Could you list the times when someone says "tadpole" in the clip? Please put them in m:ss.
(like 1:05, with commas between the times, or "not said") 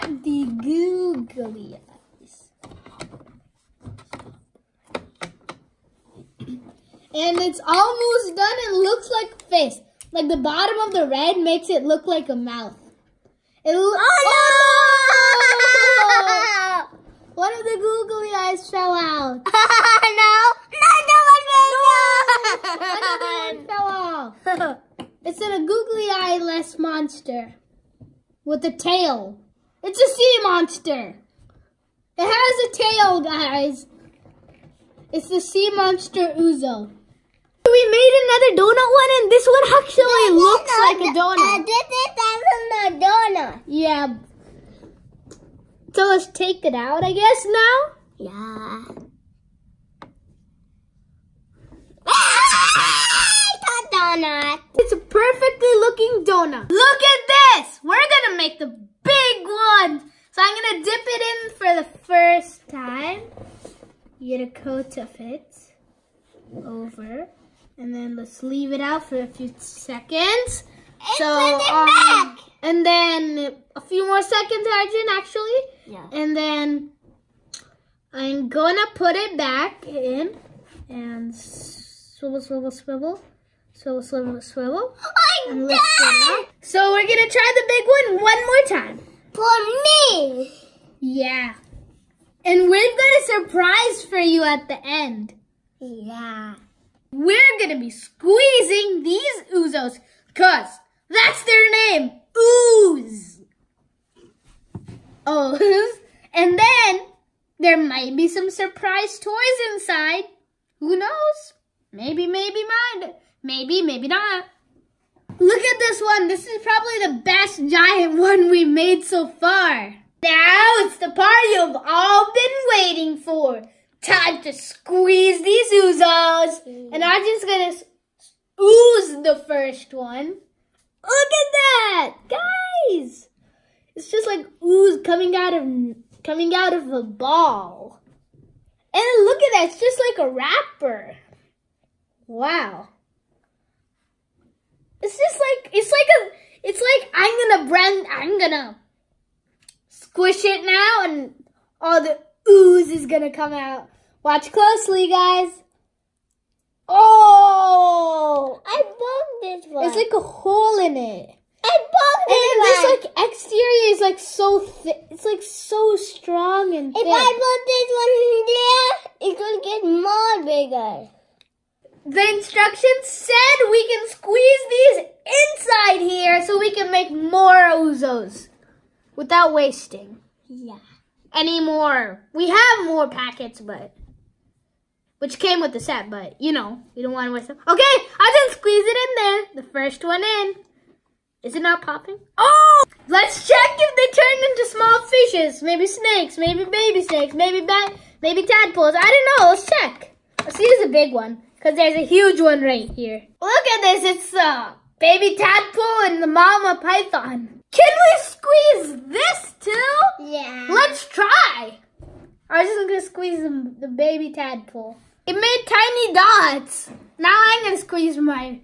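3:18, 3:25, 3:34.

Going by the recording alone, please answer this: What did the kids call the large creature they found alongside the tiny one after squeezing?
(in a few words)
mama python.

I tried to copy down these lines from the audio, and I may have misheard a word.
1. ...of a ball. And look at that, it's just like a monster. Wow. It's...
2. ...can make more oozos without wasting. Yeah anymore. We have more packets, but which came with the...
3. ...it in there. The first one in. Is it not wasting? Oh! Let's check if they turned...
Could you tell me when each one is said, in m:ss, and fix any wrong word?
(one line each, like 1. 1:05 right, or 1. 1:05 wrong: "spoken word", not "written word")
1. 2:16 wrong: "wrapper", not "monster"
2. 2:56 right
3. 3:08 wrong: "popping", not "wasting".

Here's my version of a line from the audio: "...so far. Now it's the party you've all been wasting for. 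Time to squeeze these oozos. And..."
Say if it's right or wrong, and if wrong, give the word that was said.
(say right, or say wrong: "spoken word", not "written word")
wrong: "waiting", not "wasting".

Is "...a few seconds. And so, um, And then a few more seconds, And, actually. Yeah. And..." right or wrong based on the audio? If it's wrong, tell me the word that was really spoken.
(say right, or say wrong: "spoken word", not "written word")
wrong: "Arjun", not "And".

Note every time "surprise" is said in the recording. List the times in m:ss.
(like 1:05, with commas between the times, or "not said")
1:33, 1:48.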